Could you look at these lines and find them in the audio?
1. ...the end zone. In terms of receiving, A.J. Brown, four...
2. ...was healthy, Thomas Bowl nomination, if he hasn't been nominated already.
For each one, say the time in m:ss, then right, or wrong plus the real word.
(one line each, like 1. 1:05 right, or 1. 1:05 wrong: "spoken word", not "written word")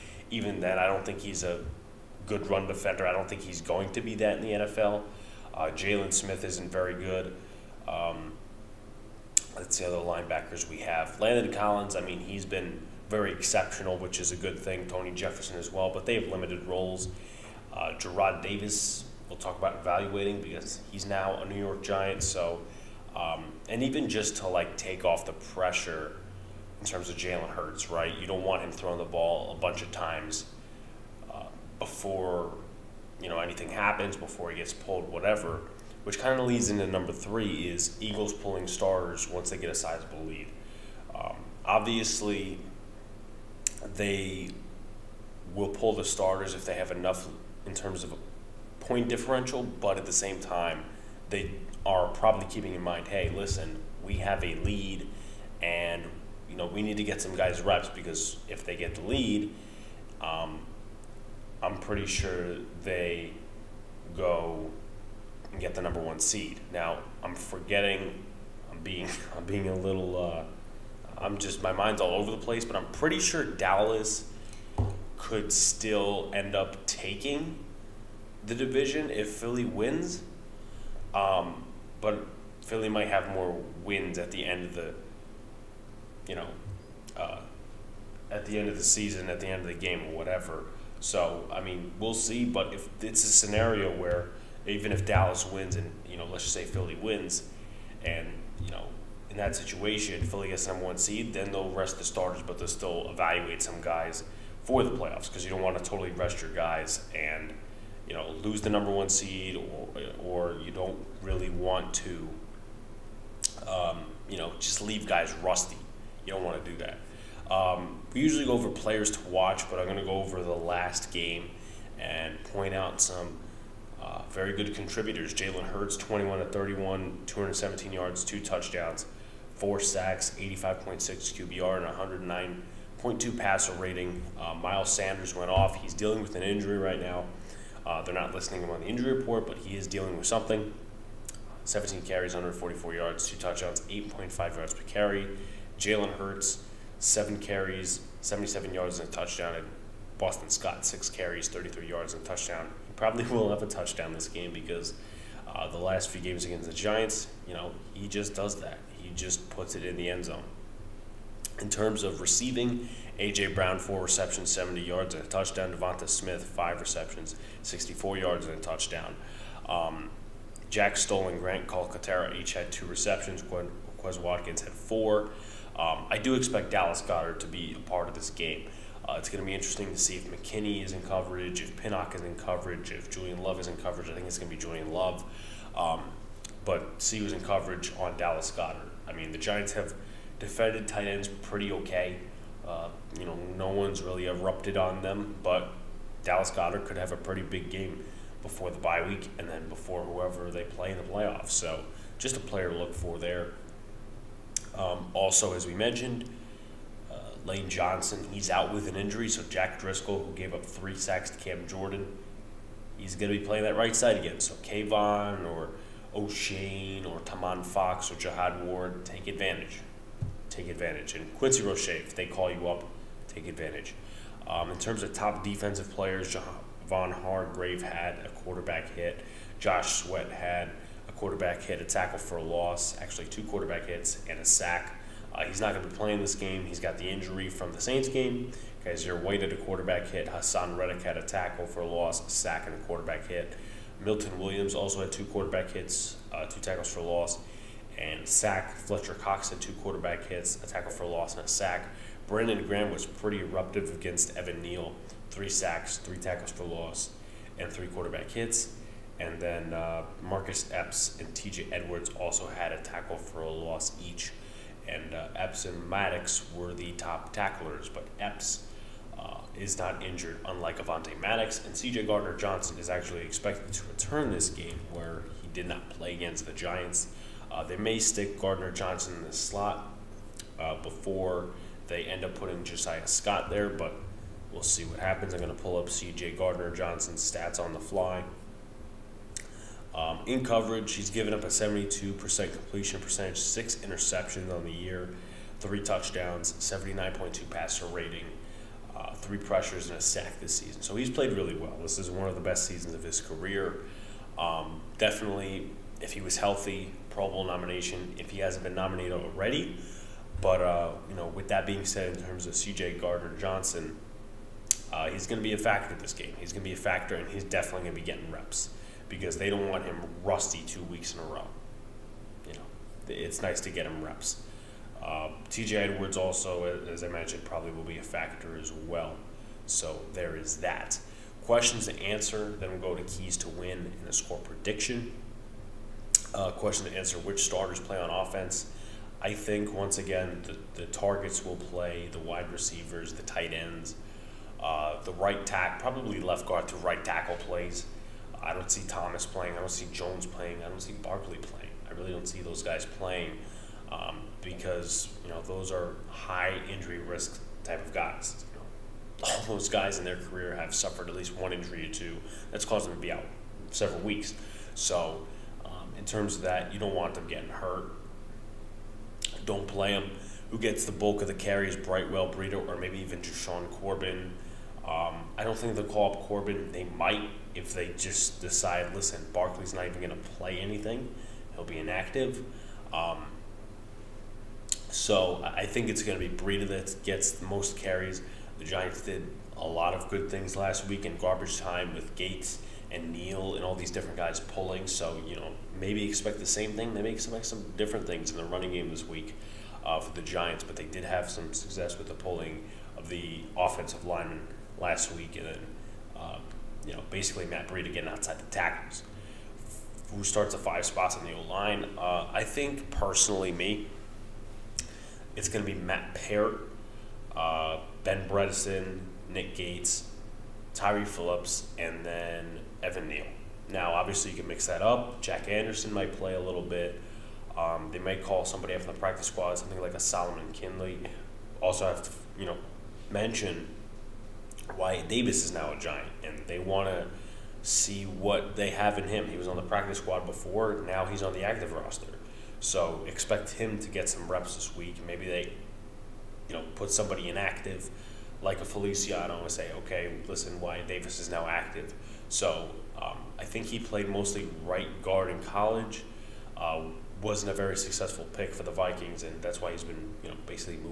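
1. 2:39 right
2. 5:06 wrong: "Pro", not "Thomas".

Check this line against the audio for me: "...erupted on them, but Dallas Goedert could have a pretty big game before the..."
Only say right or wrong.
right.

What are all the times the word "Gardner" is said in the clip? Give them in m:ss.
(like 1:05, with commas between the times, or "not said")
4:32, 4:38, 4:46, 5:12.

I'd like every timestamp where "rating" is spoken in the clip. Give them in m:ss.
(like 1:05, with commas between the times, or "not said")
2:13, 4:57.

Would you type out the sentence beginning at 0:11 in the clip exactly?
Landon Collins, I mean, he's been very exceptional, which is a good thing.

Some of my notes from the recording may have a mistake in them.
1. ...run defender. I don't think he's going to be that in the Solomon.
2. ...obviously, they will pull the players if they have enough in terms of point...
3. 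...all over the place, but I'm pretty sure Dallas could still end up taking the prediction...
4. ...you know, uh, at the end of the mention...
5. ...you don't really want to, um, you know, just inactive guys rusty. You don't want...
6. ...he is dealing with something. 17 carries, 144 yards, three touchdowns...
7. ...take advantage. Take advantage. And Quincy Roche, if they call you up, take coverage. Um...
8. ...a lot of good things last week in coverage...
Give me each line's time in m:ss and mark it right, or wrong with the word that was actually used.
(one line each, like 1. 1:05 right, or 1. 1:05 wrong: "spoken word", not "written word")
1. 0:02 wrong: "NFL", not "Solomon"
2. 0:41 wrong: "starters", not "players"
3. 1:12 wrong: "division", not "prediction"
4. 1:26 wrong: "season", not "mention"
5. 1:50 wrong: "leave", not "inactive"
6. 2:19 wrong: "two", not "three"
7. 3:39 wrong: "advantage", not "coverage"
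8. 6:29 wrong: "garbage", not "coverage".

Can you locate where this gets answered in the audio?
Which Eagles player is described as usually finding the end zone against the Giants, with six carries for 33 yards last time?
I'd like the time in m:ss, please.
2:30.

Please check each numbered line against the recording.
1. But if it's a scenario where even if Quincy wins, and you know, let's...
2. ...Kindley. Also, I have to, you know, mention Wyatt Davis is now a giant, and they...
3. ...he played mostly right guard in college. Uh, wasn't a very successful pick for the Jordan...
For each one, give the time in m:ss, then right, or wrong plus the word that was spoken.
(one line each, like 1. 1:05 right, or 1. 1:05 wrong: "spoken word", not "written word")
1. 1:32 wrong: "Dallas", not "Quincy"
2. 7:10 right
3. 7:33 wrong: "Vikings", not "Jordan".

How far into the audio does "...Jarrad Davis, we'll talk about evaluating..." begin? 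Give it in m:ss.
0:17.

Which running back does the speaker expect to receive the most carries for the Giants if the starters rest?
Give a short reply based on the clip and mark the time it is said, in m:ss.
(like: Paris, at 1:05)
Matt Breida, at 6:26.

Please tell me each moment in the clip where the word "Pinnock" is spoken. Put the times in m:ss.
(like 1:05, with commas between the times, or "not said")
3:01.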